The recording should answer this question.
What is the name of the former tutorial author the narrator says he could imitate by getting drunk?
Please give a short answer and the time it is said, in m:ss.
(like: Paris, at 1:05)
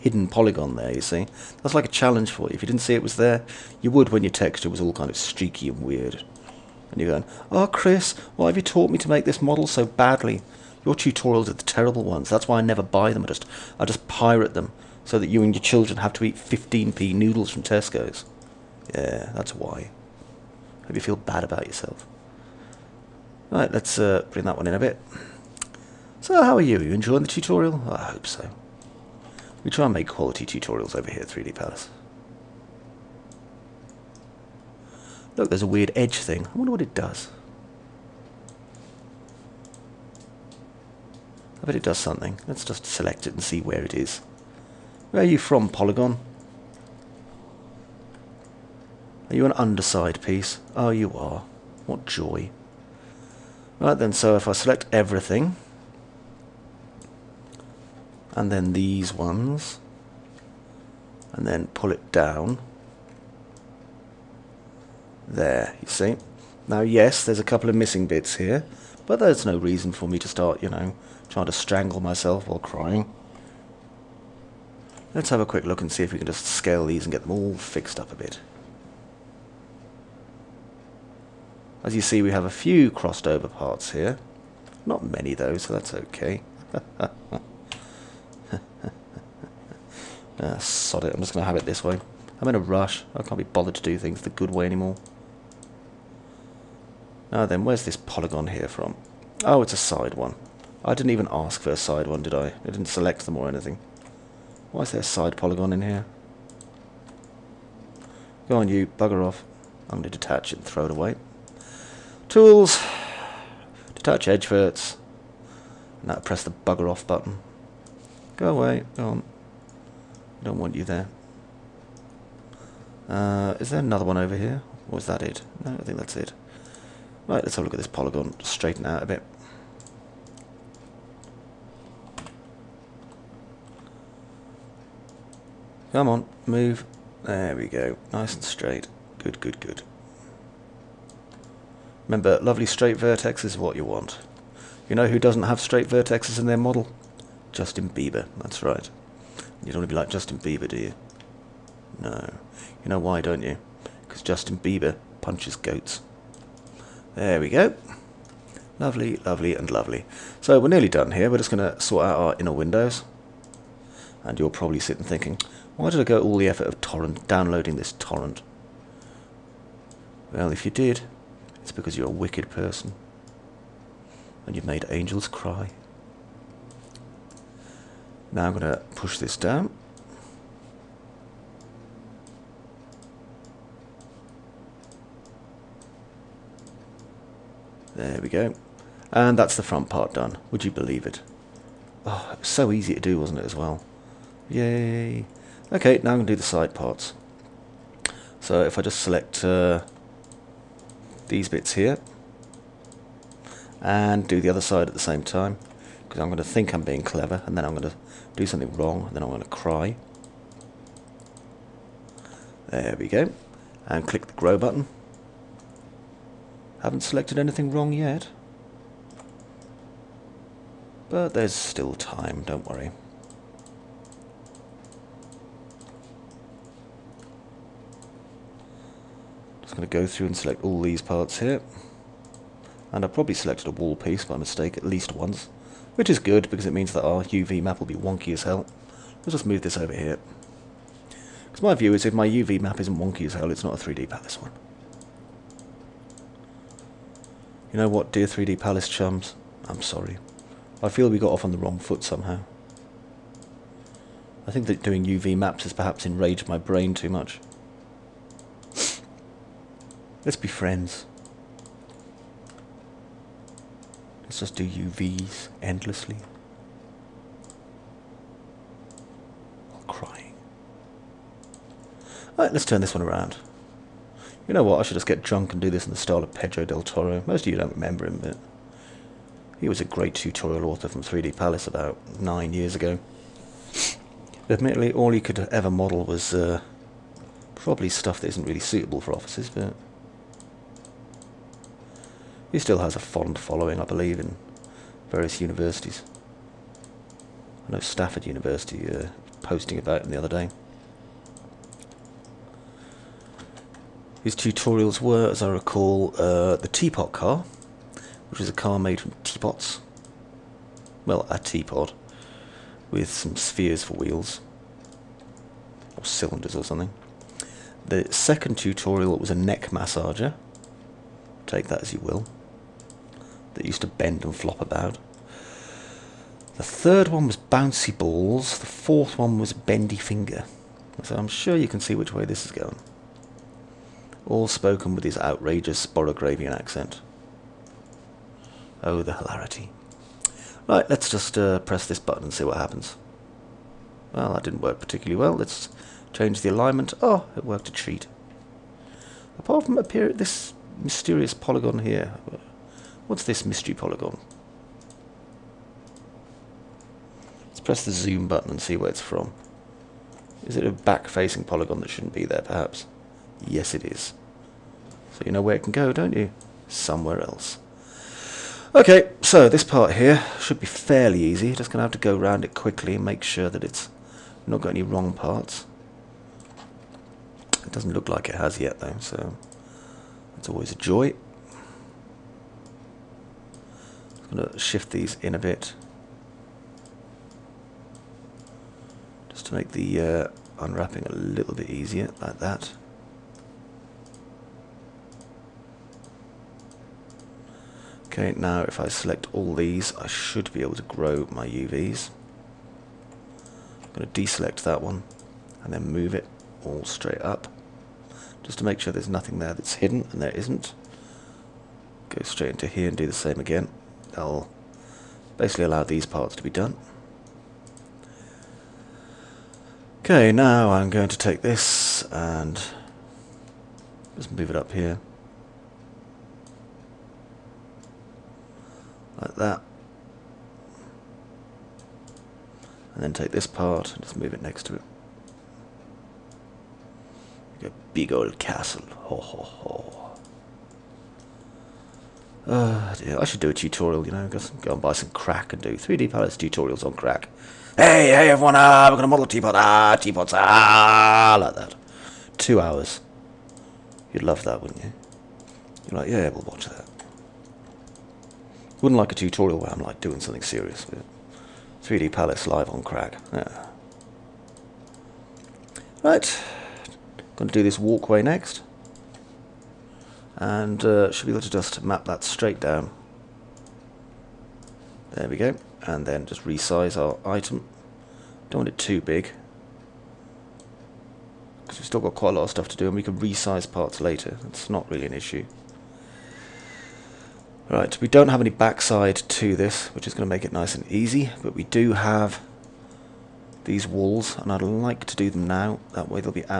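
Pedro del Toro, at 4:36.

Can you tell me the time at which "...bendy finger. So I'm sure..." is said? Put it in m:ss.
5:29.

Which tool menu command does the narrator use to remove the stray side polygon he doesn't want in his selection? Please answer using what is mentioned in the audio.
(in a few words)
Detach edge verts.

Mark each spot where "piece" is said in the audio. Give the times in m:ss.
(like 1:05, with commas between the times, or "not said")
0:50, 3:53.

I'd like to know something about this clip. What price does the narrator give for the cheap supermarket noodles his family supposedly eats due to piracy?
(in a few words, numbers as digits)
15p.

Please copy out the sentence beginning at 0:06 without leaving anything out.
And you're going, Oh, Chris, why have you taught me to make this model so badly?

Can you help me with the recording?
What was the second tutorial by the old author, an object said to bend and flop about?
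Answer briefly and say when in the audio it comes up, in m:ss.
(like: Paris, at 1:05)
A neck massager, at 5:19.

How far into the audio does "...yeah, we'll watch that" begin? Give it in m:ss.
7:36.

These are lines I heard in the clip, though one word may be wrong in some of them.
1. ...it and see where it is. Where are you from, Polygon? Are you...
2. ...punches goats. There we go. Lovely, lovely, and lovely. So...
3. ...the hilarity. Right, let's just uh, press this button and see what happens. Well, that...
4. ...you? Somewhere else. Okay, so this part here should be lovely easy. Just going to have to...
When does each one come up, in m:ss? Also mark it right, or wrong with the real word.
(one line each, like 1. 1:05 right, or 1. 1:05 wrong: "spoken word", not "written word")
1. 0:43 right
2. 2:35 right
3. 5:39 right
4. 6:06 wrong: "fairly", not "lovely".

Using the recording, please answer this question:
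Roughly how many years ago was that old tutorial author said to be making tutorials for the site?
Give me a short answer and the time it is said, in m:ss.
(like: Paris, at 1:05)
9, at 4:42.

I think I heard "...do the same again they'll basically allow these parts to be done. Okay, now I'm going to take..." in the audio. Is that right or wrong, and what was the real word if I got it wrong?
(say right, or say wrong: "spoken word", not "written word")
right.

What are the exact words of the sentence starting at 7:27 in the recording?
Hey, hey everyone, ah, we're going to model teapot, ah, teapots, ah, like that.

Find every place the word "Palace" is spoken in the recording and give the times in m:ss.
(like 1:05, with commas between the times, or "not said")
0:31, 4:04, 4:08, 4:41, 7:26, 7:42.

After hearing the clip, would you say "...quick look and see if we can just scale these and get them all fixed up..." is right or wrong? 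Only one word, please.
right.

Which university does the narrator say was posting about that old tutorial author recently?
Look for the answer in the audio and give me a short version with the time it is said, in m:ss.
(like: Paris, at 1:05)
Stafford University, at 4:57.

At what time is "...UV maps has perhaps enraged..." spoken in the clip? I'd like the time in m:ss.
4:15.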